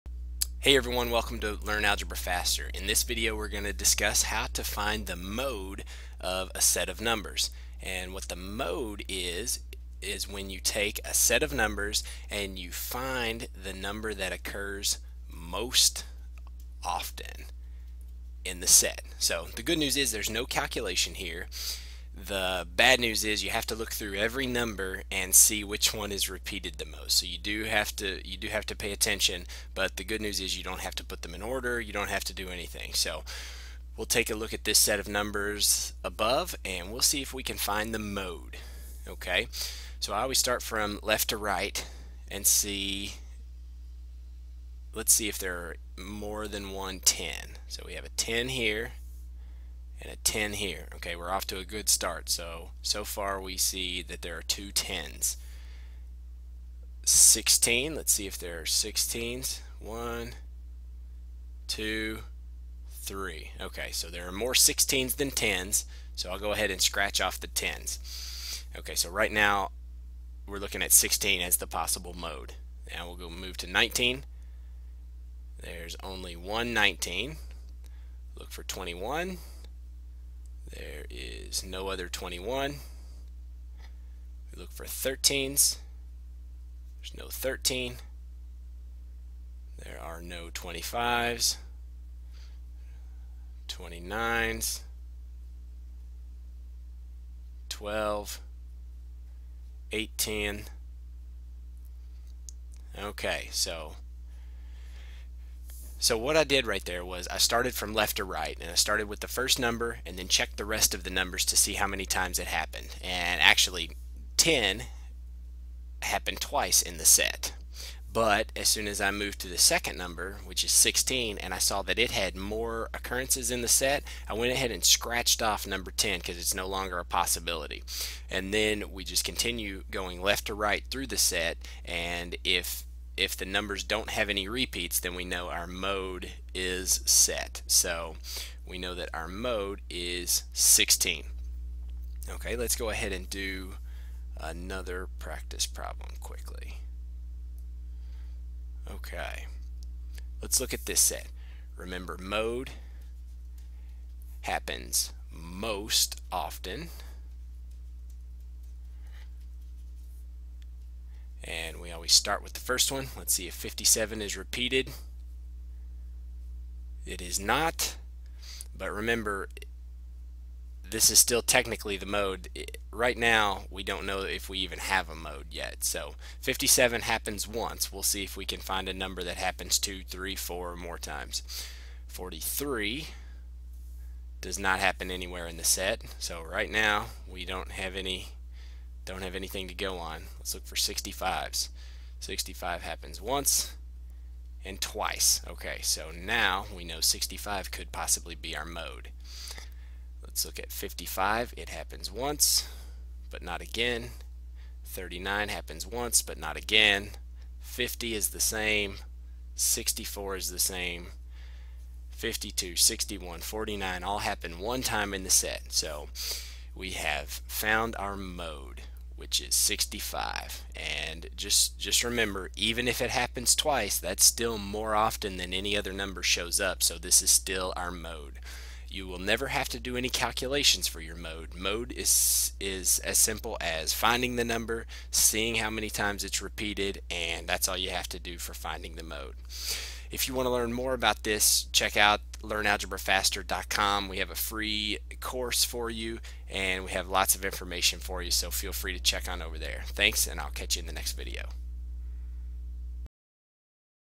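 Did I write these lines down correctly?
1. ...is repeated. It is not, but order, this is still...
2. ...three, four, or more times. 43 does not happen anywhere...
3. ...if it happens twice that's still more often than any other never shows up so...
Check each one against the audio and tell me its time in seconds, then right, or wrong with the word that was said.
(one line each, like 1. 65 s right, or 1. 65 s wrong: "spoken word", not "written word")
1. 164 s wrong: "remember", not "order"
2. 180 s right
3. 222 s wrong: "number", not "never".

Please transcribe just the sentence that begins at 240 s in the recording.
If you want to learn more about this, check out learnalgebrafaster.com.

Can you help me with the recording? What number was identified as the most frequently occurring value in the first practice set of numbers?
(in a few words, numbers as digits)
16.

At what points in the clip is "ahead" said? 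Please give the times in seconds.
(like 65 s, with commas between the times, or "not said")
66 s, 124 s, 142 s.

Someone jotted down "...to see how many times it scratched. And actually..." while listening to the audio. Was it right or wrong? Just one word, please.
wrong.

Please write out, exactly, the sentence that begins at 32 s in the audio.
So we'll take a look at this set of numbers above and we'll see if we can find the mode.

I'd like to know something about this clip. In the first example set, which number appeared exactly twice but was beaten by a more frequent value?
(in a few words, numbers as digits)
10.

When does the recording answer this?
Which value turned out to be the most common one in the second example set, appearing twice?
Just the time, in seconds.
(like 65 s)
217 s.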